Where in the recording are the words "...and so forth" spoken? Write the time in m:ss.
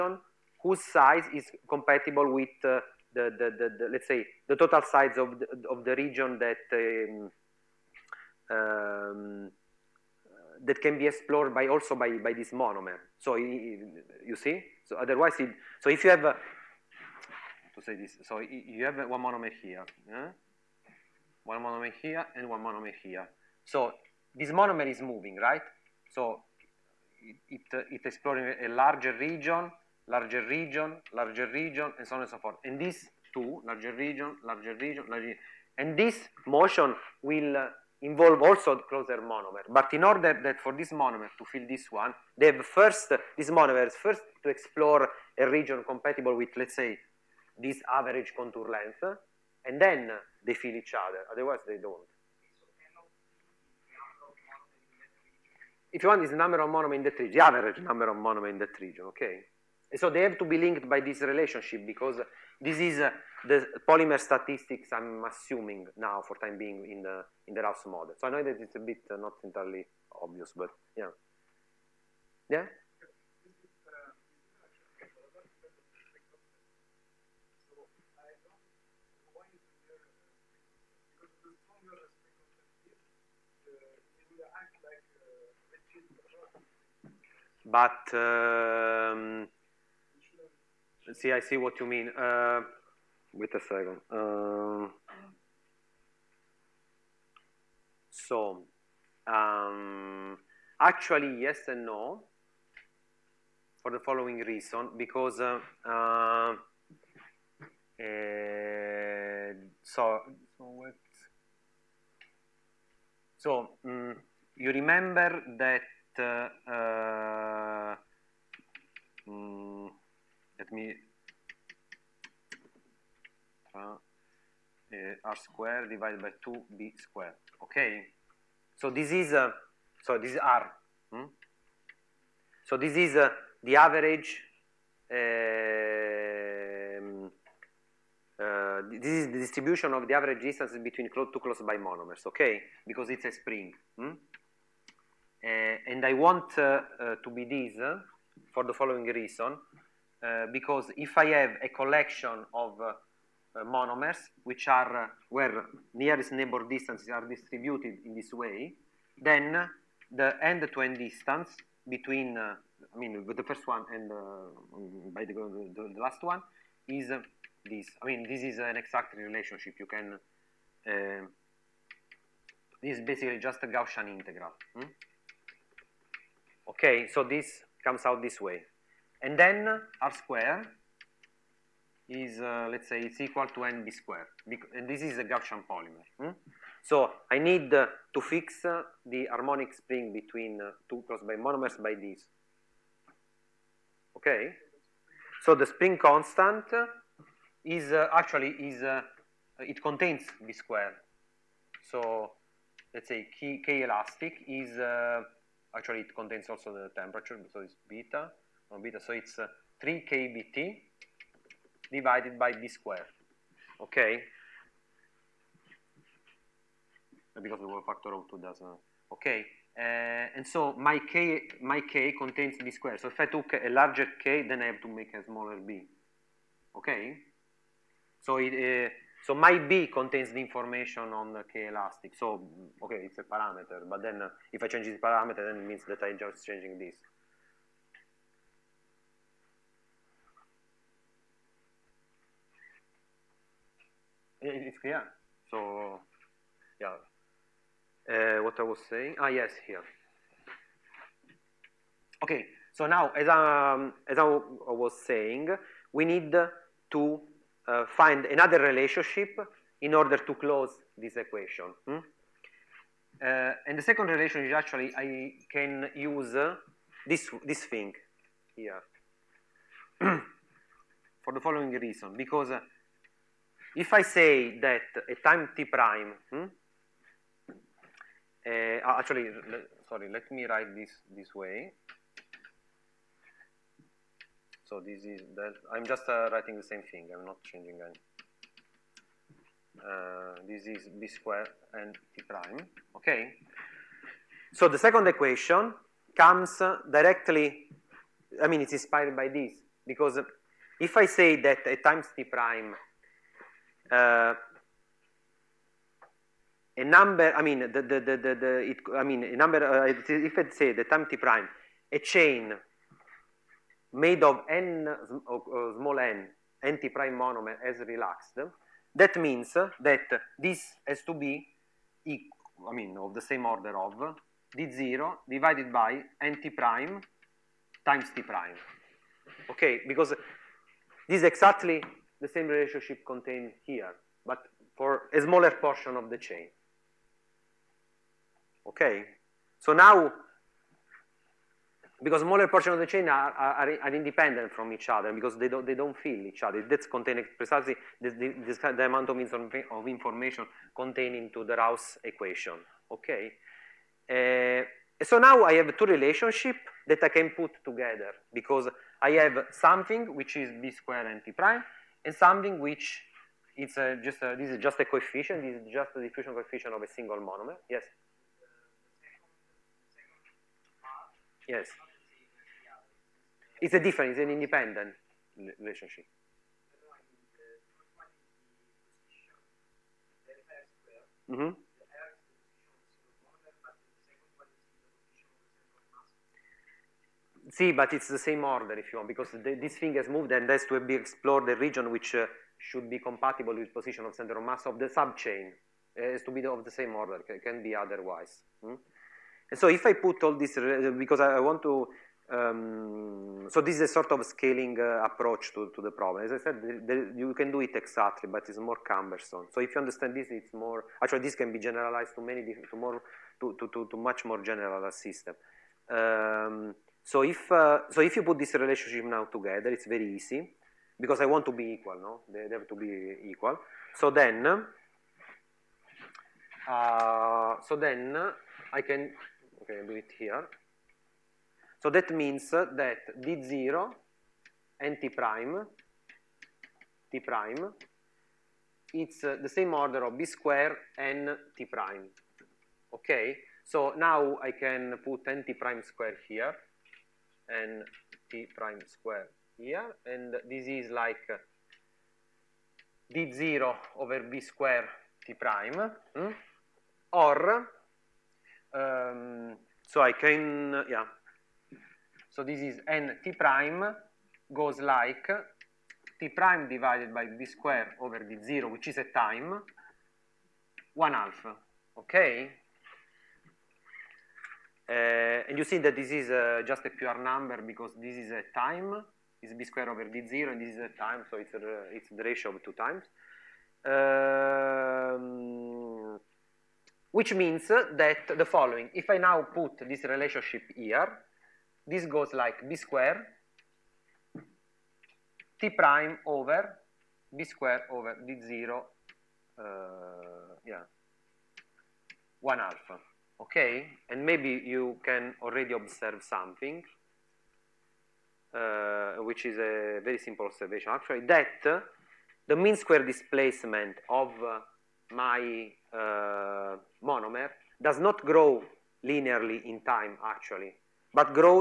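0:32.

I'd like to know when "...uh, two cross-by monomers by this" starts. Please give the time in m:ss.
3:10.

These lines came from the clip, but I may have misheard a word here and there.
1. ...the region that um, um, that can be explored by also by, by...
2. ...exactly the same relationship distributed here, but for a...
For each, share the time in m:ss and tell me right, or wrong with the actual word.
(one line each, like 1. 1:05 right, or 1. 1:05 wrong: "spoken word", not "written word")
1. 0:05 right
2. 5:31 wrong: "contained", not "distributed".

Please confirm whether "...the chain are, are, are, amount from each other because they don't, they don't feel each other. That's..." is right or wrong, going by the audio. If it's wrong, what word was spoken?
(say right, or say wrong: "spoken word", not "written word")
wrong: "independent", not "amount".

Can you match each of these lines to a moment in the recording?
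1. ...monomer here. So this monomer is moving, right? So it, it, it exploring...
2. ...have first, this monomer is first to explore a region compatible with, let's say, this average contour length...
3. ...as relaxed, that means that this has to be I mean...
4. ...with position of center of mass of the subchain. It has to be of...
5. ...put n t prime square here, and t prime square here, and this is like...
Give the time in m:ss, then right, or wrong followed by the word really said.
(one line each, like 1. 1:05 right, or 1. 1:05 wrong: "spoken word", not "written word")
1. 0:22 right
2. 0:42 right
3. 5:17 right
4. 6:33 right
5. 7:25 right.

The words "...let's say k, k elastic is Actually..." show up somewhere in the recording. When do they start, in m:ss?
3:22.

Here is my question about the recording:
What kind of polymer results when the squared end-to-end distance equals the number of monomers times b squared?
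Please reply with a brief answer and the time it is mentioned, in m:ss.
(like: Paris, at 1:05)
Gaussian polymer, at 3:05.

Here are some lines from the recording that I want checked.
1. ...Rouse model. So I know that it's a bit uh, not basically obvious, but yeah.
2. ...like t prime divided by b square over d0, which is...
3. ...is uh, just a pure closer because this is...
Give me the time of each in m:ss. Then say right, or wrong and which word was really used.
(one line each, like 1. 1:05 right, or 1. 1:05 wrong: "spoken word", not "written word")
1. 1:07 wrong: "entirely", not "basically"
2. 7:44 right
3. 7:56 wrong: "number", not "closer".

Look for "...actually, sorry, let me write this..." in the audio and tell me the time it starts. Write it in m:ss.
4:38.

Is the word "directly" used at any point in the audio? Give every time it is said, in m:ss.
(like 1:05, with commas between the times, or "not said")
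4:56.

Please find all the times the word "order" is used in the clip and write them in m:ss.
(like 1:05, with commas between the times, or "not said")
0:40, 4:19, 5:23, 6:28, 6:36, 7:19.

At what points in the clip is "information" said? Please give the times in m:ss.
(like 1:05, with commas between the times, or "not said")
3:50, 5:49.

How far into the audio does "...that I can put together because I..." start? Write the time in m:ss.
5:56.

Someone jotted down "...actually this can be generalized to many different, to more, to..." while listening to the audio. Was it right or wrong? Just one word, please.
right.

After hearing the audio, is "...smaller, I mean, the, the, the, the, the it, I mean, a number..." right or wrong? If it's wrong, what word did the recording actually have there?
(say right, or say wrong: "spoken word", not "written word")
wrong: "number", not "smaller".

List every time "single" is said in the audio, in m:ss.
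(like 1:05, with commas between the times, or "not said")
6:06.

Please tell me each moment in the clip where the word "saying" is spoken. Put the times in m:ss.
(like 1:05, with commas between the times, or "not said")
4:08, 4:15.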